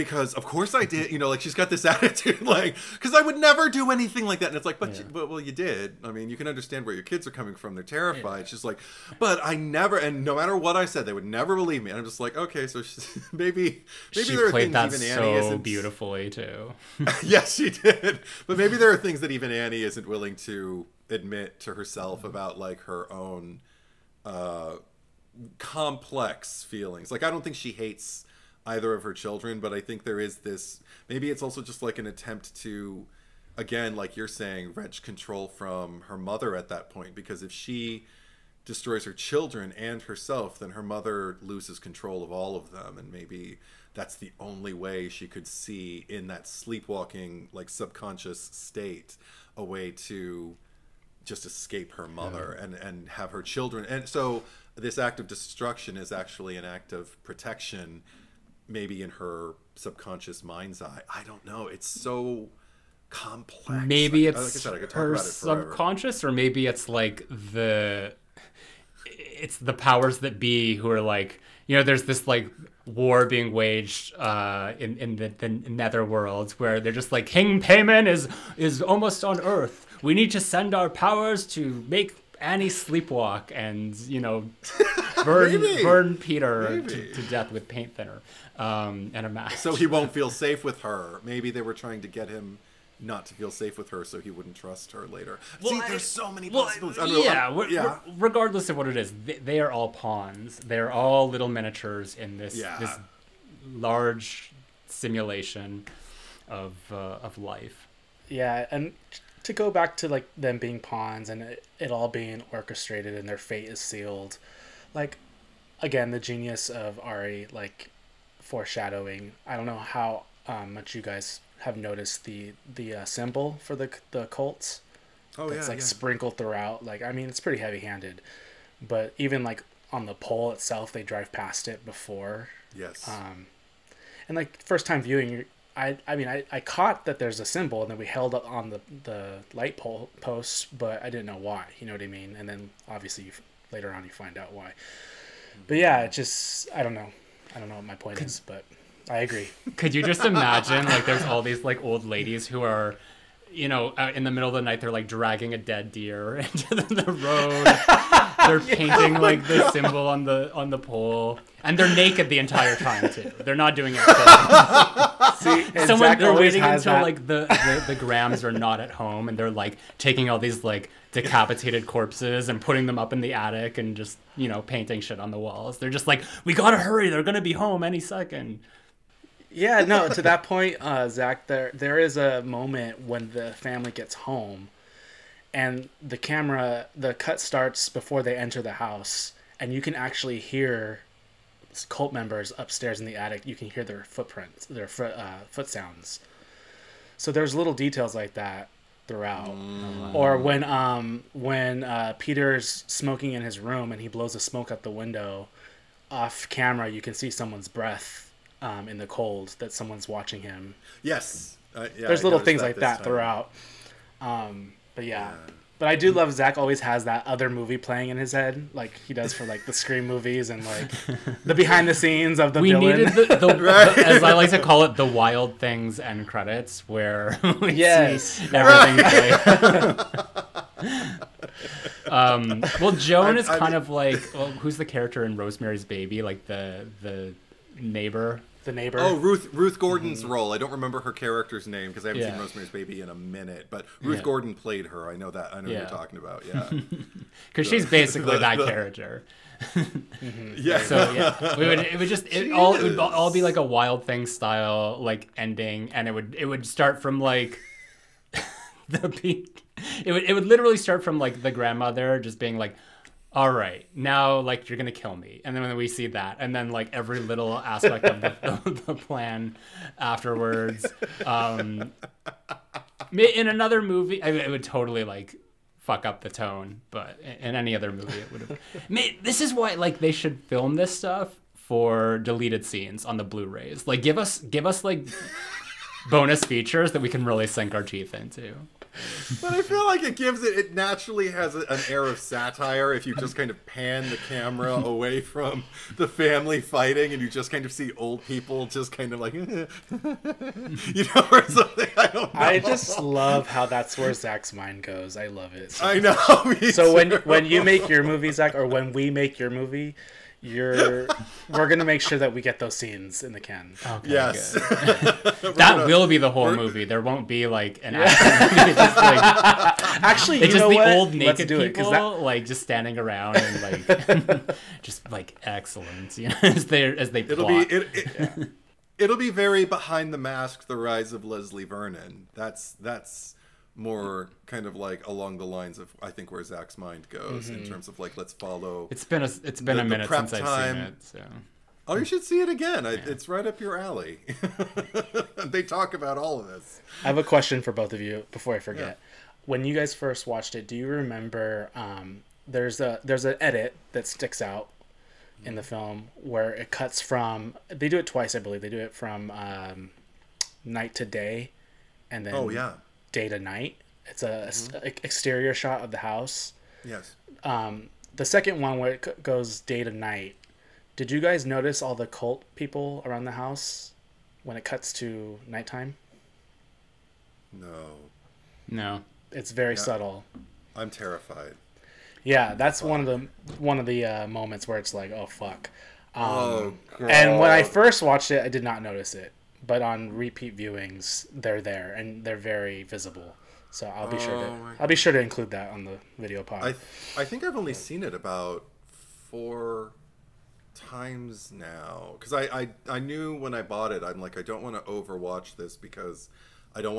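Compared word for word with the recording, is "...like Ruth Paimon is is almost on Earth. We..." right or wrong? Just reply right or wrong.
wrong.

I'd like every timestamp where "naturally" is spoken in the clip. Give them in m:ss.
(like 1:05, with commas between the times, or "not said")
4:50.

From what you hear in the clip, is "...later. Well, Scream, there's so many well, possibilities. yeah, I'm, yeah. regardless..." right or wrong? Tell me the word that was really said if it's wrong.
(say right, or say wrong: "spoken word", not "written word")
wrong: "See", not "Scream".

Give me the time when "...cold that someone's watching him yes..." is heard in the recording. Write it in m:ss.
3:29.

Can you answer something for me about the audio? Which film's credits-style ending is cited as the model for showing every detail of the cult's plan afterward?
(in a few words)
Wild Things.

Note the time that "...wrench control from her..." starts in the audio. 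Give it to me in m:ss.
0:34.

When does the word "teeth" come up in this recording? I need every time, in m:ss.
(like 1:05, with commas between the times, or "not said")
4:47.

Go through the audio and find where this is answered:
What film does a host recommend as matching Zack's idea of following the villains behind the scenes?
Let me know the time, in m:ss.
5:29.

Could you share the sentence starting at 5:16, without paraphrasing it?
There won't be like an yeah.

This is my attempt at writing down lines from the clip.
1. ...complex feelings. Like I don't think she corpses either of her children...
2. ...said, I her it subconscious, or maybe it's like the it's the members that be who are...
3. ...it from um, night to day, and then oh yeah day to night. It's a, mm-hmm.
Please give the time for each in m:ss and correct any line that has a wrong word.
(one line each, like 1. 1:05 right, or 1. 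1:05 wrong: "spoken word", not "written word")
1. 0:25 wrong: "hates", not "corpses"
2. 1:04 wrong: "powers", not "members"
3. 5:58 right.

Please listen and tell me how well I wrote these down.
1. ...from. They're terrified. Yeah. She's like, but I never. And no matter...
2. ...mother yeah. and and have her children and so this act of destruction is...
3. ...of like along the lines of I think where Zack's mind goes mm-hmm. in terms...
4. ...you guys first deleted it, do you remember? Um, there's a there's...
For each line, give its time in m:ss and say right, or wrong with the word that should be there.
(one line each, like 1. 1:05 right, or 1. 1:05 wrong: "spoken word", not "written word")
1. 0:07 right
2. 0:52 right
3. 5:34 right
4. 5:49 wrong: "watched", not "deleted".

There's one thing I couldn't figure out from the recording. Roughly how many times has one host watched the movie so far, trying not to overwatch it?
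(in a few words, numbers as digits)
4.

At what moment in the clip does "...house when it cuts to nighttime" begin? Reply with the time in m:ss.
6:13.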